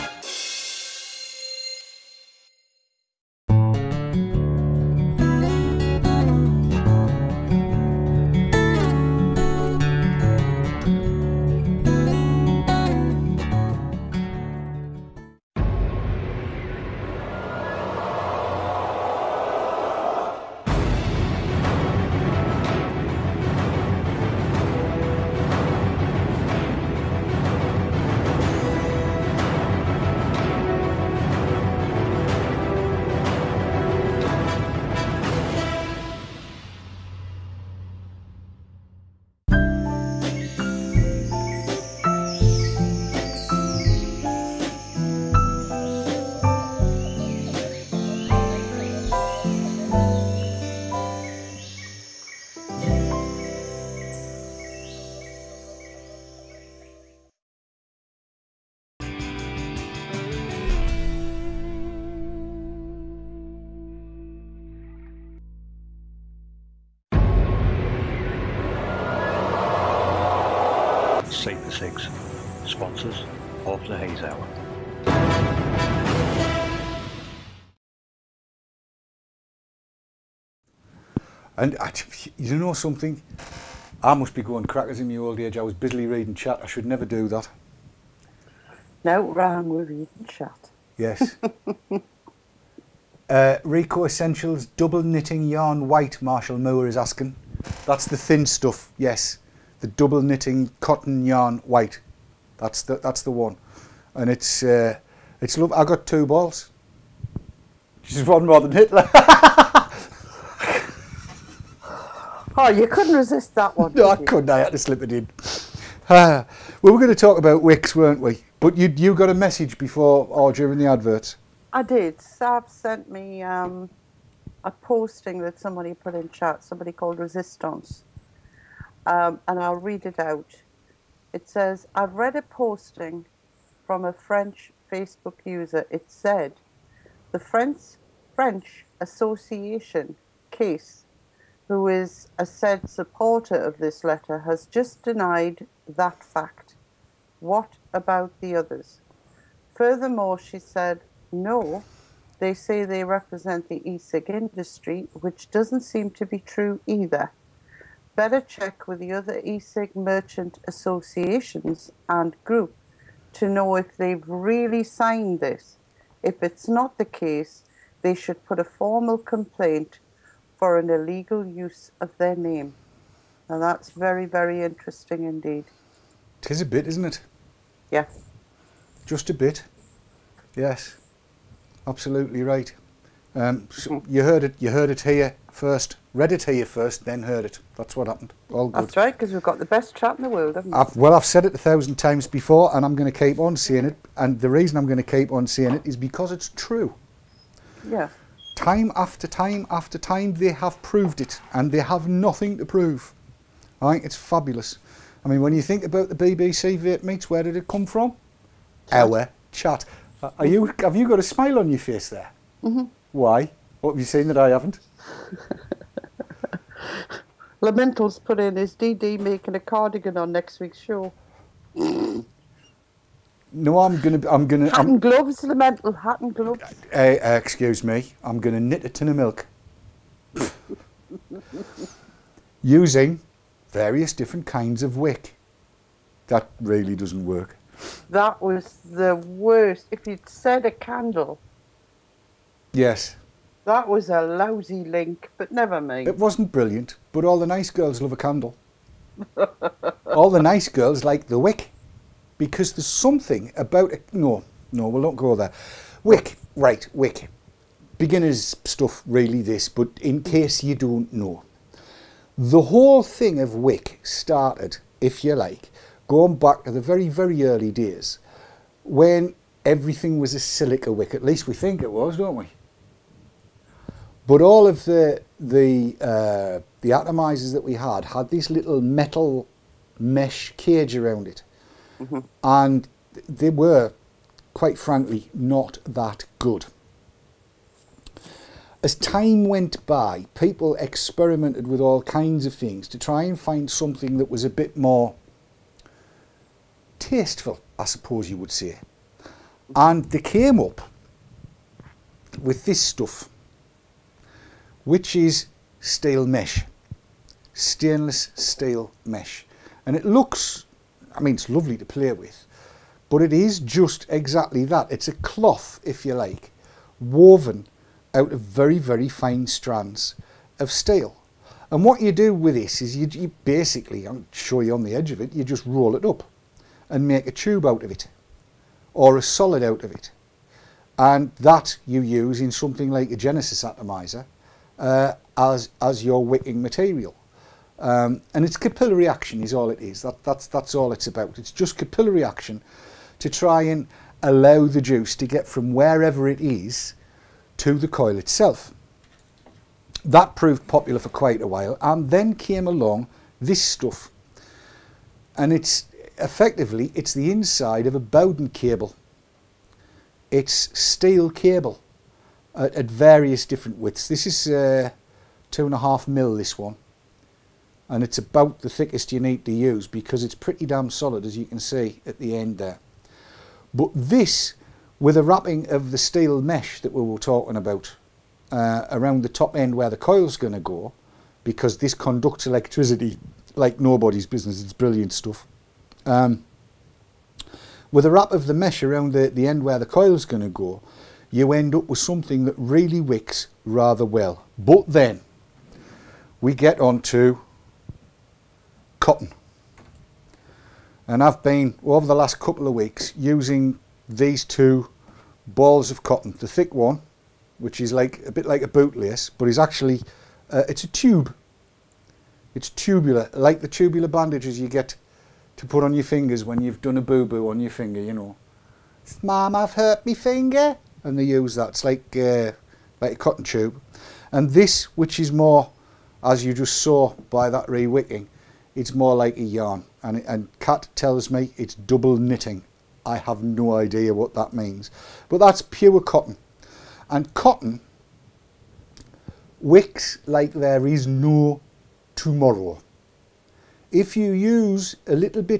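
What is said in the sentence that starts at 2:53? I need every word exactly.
Now that's very, very interesting indeed.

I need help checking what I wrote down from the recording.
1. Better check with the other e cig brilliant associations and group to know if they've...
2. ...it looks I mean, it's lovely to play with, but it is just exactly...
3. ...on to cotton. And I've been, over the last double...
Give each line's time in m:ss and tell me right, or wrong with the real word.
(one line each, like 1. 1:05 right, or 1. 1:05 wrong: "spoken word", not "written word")
1. 2:38 wrong: "merchant", not "brilliant"
2. 5:09 right
3. 6:36 wrong: "couple", not "double".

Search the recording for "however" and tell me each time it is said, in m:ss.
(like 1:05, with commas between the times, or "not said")
not said.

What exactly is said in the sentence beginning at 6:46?
The thick one, which is like a bit like a bootlace, but is actually, uh, it's a tube.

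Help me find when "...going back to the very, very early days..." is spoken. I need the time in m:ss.
4:26.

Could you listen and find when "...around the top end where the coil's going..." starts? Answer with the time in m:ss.
6:18.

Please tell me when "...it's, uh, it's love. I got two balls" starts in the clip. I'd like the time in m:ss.
1:44.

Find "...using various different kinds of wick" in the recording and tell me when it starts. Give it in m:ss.
3:52.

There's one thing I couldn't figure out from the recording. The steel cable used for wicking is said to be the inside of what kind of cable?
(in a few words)
Bowden cable.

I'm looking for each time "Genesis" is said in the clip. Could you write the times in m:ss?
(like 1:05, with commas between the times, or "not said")
5:33.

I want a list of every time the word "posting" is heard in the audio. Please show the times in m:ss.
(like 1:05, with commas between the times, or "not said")
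2:04, 2:12.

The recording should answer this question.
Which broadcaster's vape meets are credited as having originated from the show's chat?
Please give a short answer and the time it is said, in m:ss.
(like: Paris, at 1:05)
BBC, at 3:26.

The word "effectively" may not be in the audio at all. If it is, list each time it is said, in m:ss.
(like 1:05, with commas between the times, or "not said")
5:56.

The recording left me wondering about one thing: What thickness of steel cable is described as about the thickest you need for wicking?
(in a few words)
2.5 mm.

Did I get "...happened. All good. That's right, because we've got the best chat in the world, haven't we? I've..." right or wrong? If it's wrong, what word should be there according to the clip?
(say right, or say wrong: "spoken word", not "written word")
right.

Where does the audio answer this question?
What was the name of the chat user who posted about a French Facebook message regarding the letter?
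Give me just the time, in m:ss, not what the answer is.
2:07.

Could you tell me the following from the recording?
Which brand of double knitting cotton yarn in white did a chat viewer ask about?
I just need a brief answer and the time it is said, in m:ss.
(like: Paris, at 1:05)
Rico Essentials, at 1:33.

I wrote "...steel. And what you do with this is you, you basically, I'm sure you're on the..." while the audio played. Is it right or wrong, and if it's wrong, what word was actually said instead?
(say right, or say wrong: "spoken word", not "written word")
right.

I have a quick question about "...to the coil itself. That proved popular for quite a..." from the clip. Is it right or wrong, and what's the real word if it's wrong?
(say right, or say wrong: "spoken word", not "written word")
right.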